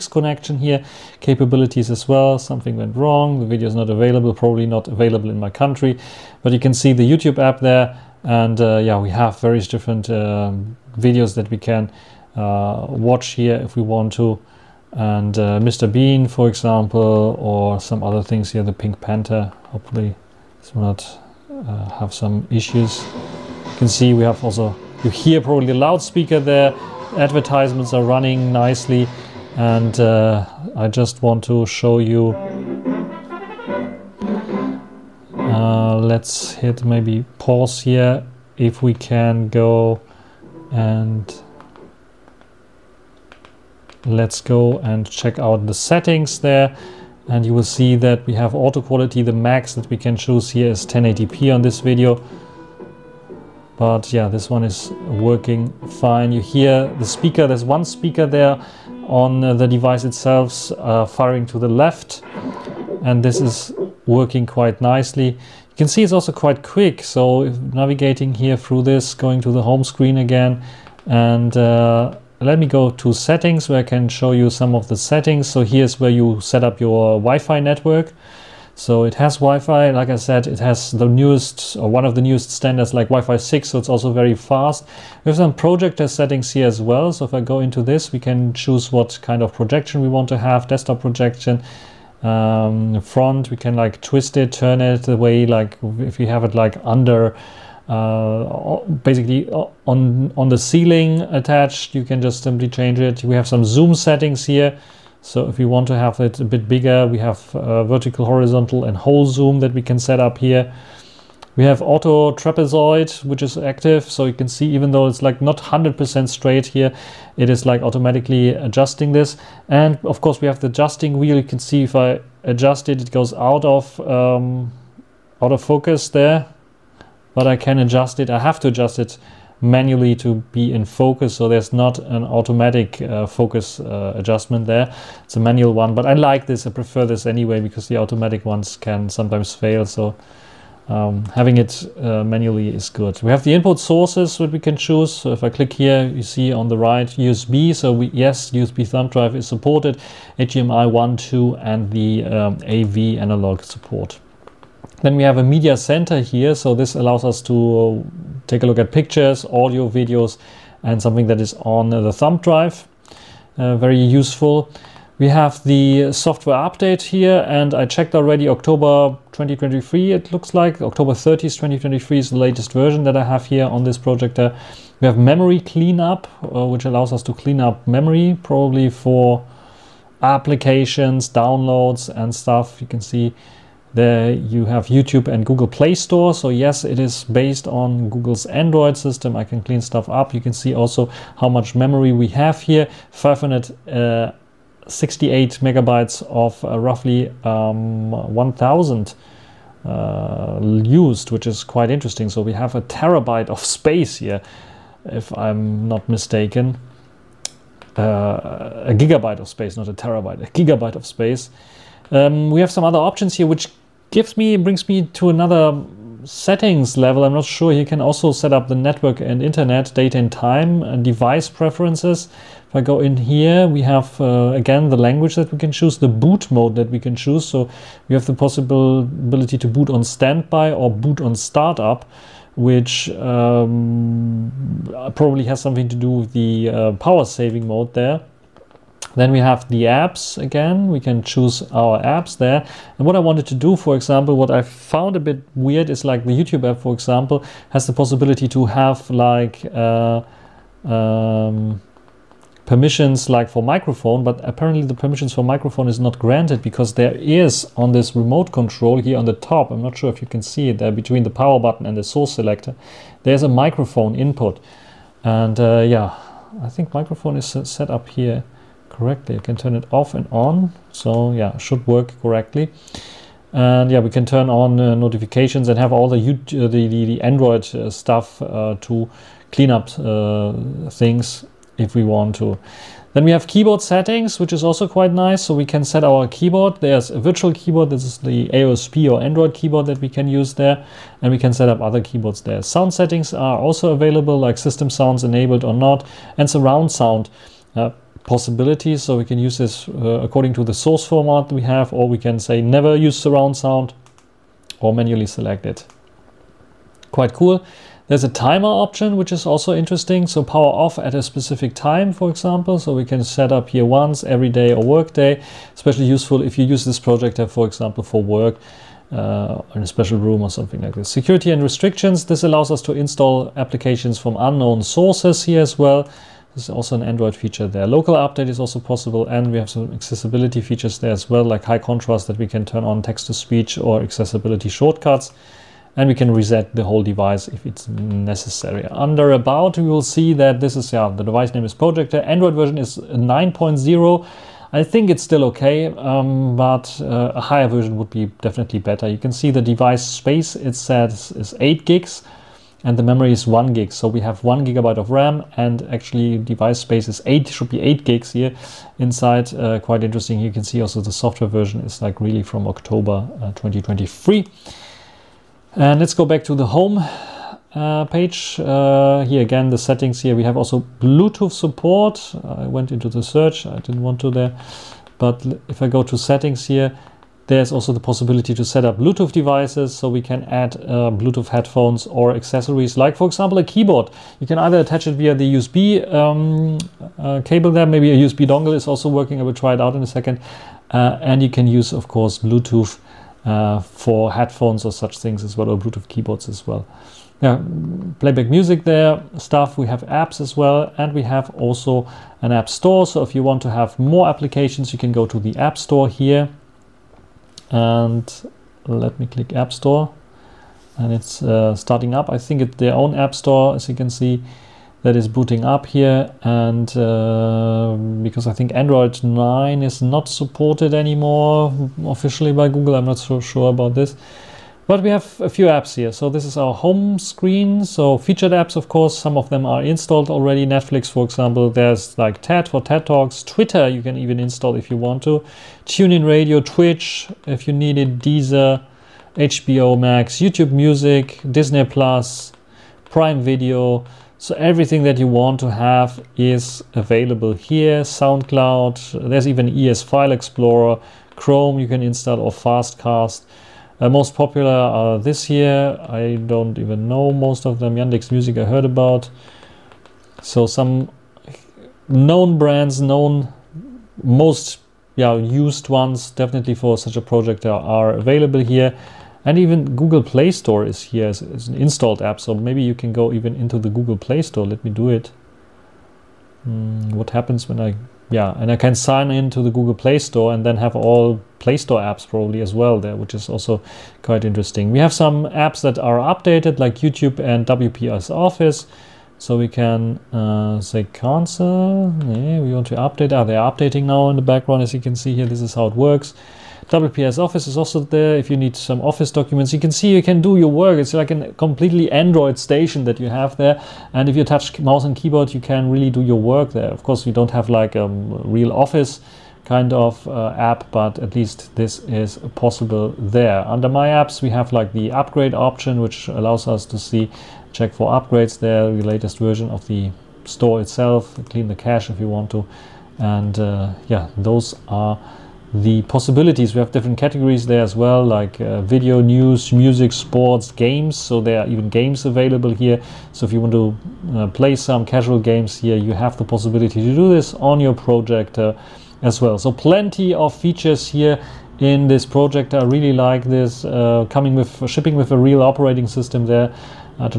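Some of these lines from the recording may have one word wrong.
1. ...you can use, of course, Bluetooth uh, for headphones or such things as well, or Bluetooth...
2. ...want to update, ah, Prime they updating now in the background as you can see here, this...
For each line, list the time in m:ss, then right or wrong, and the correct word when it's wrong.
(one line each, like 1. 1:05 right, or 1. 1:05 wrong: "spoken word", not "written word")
1. 6:31 right
2. 8:12 wrong: "Are", not "Prime".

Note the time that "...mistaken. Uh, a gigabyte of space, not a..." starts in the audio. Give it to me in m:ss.
3:26.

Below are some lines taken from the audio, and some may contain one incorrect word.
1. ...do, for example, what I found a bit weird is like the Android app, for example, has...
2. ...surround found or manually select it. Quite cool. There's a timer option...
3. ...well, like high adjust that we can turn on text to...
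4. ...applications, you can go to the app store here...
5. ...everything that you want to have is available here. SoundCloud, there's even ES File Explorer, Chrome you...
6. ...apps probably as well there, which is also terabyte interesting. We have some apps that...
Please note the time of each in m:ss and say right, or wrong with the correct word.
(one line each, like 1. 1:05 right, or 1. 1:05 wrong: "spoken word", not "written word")
1. 4:03 wrong: "YouTube", not "Android"
2. 5:03 wrong: "sound", not "found"
3. 5:31 wrong: "contrast", not "adjust"
4. 6:44 right
5. 7:24 right
6. 8:01 wrong: "quite", not "terabyte".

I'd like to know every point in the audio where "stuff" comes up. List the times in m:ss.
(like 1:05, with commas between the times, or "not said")
3:02, 3:09, 4:37, 6:39.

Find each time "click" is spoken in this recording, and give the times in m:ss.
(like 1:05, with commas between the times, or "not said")
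2:25, 6:49.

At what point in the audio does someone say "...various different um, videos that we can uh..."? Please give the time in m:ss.
0:09.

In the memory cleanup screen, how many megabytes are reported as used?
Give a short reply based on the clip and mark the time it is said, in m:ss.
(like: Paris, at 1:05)
568, at 3:13.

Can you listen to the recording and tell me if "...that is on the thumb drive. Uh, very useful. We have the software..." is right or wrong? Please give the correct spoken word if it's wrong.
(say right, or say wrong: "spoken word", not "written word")
right.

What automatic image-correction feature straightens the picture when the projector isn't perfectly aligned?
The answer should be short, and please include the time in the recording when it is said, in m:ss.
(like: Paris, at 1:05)
auto trapezoid, at 1:51.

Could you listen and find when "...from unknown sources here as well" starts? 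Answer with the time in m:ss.
5:24.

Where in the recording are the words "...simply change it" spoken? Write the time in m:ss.
1:42.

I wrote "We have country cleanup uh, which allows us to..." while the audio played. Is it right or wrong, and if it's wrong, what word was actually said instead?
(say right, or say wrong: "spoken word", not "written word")
wrong: "memory", not "country".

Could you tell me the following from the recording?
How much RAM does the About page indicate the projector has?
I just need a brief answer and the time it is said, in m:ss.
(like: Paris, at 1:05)
1 gigabyte, at 5:54.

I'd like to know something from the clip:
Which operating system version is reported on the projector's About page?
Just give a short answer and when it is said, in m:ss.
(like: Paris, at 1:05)
Android 9.0, at 5:42.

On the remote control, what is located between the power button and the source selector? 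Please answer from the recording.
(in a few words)
microphone input.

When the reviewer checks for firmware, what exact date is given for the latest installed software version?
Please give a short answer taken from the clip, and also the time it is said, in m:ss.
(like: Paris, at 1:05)
October 30th 2023, at 2:50.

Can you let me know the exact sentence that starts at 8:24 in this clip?
And if you touch mouse and keyboard, you can really do your work there.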